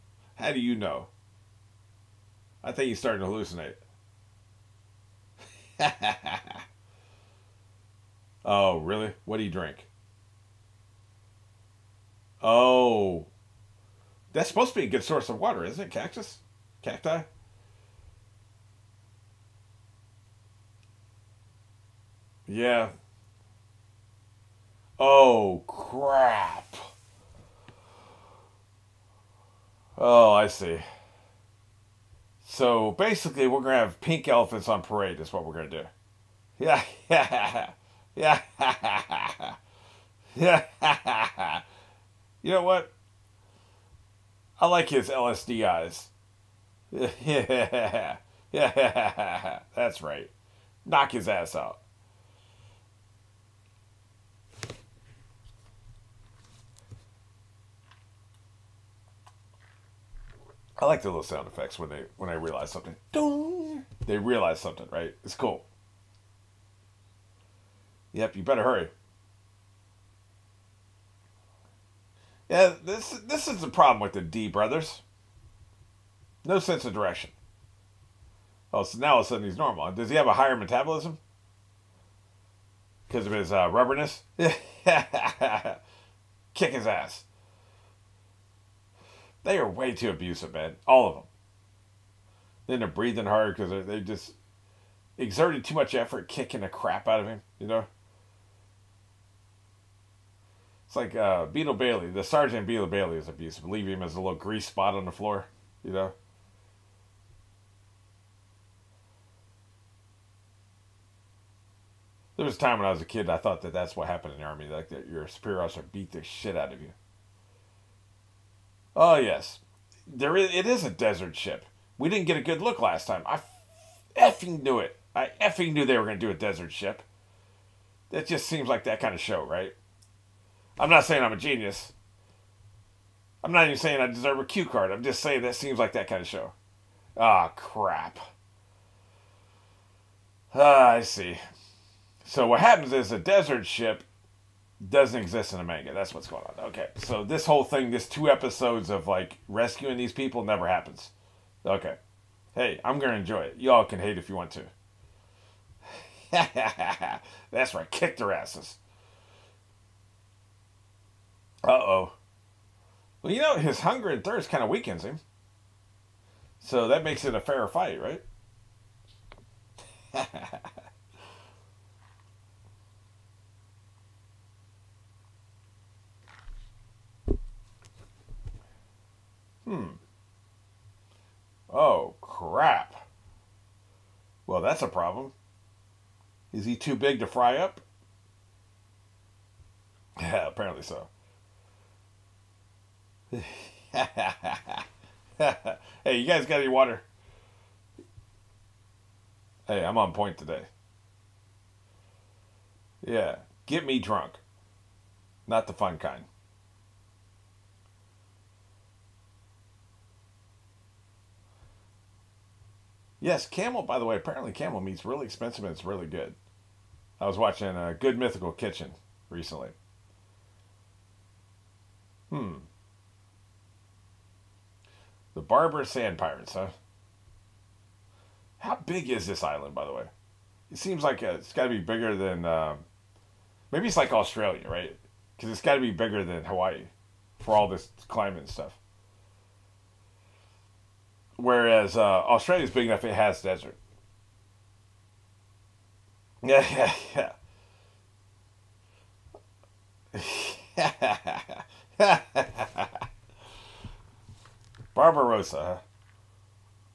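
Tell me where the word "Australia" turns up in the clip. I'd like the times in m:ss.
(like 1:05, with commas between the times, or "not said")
3:54, 4:02.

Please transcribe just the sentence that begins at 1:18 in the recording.
Oh, so now all of a sudden he's normal.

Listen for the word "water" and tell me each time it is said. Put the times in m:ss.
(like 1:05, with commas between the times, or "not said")
0:15, 3:16.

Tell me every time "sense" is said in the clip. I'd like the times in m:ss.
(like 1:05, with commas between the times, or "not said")
1:16.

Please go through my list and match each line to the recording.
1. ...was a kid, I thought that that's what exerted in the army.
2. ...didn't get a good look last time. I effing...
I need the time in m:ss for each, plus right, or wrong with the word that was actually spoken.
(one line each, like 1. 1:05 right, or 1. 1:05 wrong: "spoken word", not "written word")
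1. 1:52 wrong: "happened", not "exerted"
2. 2:02 right.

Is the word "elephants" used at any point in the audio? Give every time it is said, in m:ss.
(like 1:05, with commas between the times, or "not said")
0:34.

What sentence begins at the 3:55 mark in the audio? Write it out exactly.
Because it's got to be bigger than Hawaii for all this climate and stuff.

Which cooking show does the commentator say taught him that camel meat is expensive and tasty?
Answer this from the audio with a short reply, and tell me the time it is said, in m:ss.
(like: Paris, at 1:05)
Good Mythical Kitchen, at 3:37.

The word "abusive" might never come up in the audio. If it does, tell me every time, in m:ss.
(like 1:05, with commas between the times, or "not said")
1:30, 1:43.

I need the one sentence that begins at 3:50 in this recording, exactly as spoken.
It seems like uh, it's got to be bigger than.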